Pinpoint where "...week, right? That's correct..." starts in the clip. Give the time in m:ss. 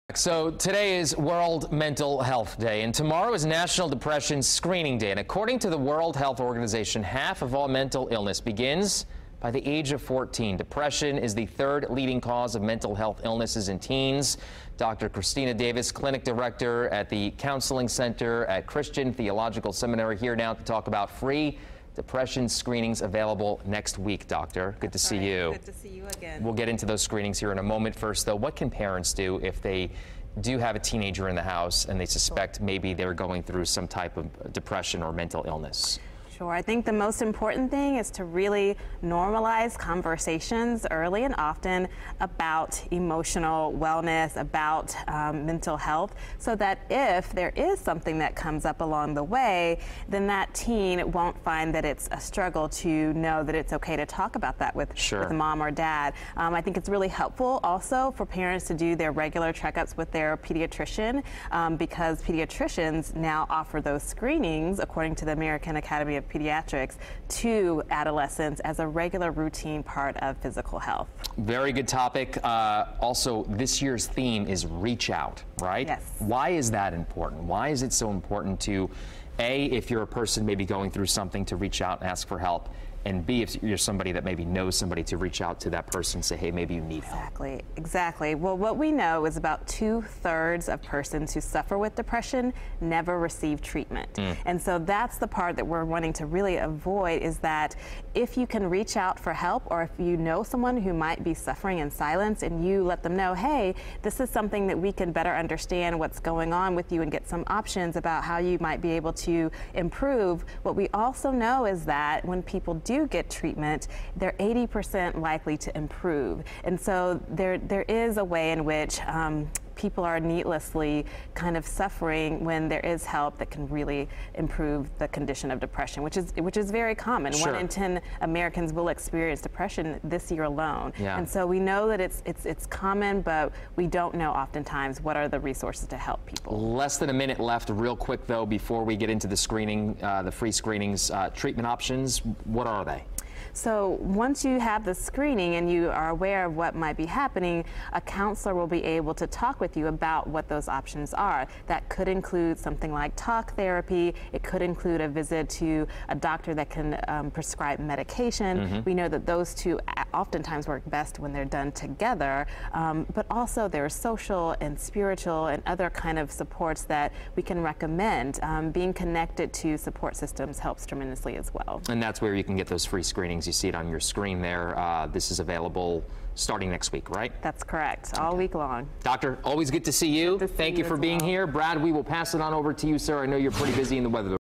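2:56.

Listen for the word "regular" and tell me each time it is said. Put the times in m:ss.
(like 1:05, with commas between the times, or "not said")
0:59, 1:08.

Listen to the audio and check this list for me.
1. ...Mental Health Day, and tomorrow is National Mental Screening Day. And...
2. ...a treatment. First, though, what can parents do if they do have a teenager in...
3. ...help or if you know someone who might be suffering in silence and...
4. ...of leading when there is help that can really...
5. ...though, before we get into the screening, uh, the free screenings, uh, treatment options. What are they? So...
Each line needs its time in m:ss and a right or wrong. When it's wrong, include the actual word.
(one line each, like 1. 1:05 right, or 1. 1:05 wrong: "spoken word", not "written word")
1. 0:01 wrong: "Depression", not "Mental"
2. 0:27 wrong: "moment", not "treatment"
3. 1:39 right
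4. 2:01 wrong: "suffering", not "leading"
5. 2:18 right.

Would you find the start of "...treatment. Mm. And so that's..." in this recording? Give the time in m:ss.
1:33.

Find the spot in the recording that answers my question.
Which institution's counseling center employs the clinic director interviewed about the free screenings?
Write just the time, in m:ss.
0:18.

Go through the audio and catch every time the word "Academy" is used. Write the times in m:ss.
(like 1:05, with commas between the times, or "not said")
1:05.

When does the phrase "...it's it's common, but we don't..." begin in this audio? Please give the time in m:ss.
2:12.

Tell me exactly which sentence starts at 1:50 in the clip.
What we also know is that when people do get treatment, they're 80% likely to improve.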